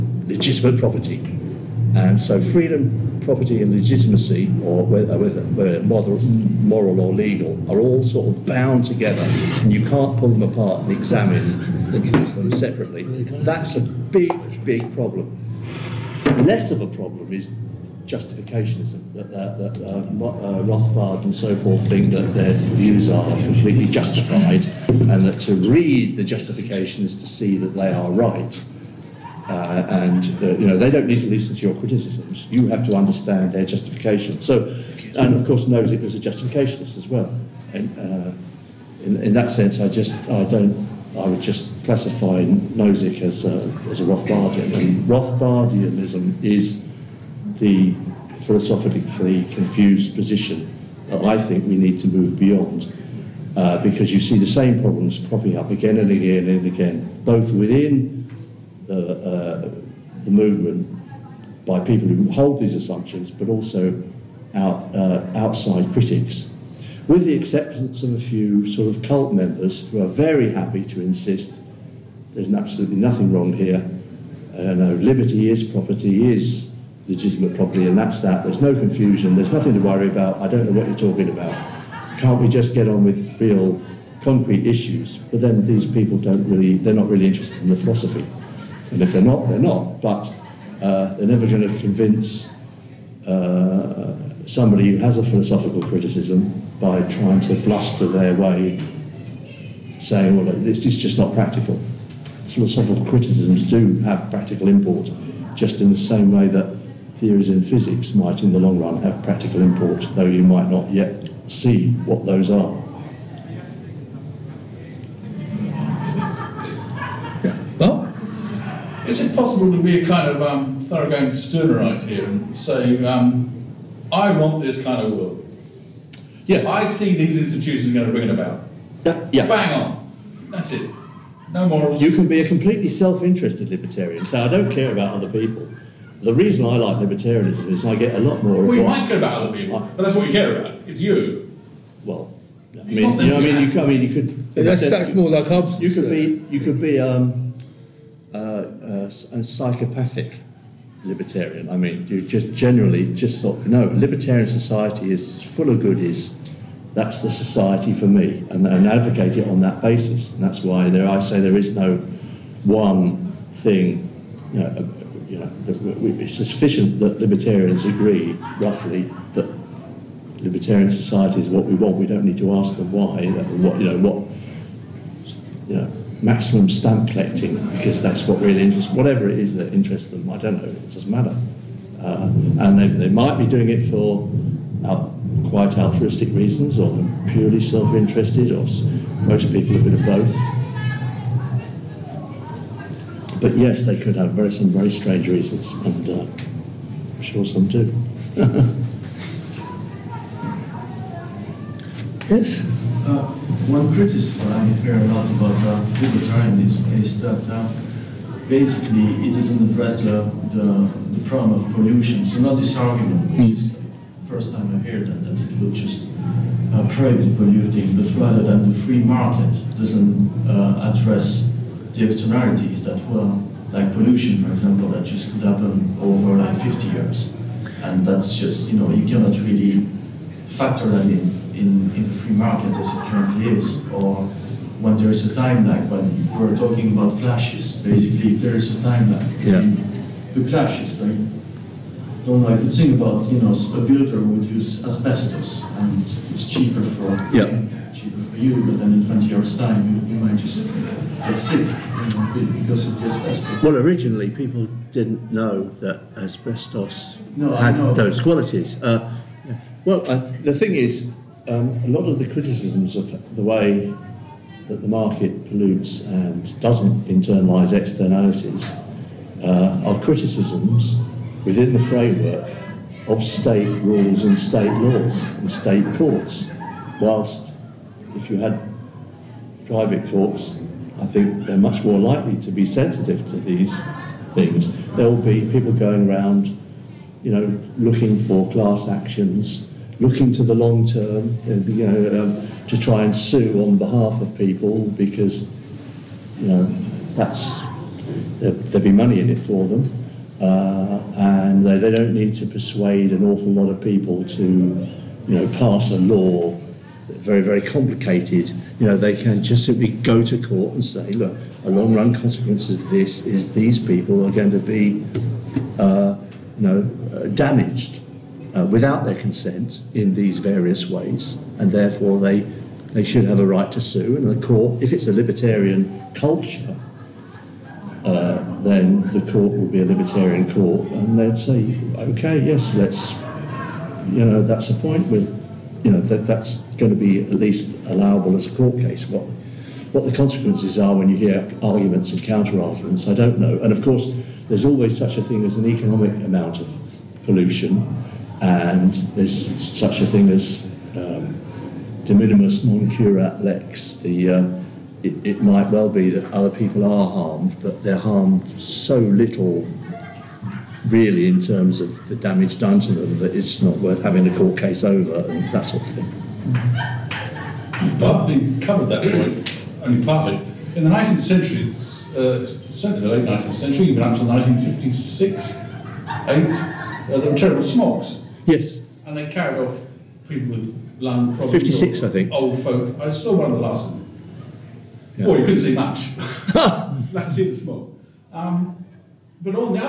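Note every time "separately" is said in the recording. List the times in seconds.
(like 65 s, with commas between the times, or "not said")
12 s.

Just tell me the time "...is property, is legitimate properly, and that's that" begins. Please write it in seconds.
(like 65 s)
75 s.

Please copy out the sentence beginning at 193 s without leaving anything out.
But yes, they could have very some very strange reasons, and uh, I'm sure some do.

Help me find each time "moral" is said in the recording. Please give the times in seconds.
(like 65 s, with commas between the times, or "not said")
5 s, 131 s.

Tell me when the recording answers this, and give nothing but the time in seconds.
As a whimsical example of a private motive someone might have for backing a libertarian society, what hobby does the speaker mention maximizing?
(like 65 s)
176 s.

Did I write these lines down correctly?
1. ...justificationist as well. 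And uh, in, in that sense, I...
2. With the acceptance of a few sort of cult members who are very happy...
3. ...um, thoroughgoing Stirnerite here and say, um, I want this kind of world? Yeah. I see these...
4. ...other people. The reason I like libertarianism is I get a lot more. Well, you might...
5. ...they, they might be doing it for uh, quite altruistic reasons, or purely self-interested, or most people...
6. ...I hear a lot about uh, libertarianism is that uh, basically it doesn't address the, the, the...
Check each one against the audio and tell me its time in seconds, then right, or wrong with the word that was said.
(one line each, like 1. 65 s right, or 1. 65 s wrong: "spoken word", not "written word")
1. 36 s right
2. 67 s right
3. 120 s right
4. 135 s right
5. 182 s right
6. 204 s right.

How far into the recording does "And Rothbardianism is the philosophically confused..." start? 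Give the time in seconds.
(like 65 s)
44 s.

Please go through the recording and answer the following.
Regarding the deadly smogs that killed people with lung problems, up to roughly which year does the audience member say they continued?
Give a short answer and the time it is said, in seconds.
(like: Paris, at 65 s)
1956, at 374 s.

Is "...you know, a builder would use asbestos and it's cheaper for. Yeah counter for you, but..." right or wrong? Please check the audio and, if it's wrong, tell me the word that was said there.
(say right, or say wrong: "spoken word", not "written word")
wrong: "cheaper", not "counter".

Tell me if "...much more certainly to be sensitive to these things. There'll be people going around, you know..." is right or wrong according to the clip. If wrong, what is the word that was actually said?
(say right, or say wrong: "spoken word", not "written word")
wrong: "likely", not "certainly".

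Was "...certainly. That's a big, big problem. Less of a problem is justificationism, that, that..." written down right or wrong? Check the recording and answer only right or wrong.
wrong.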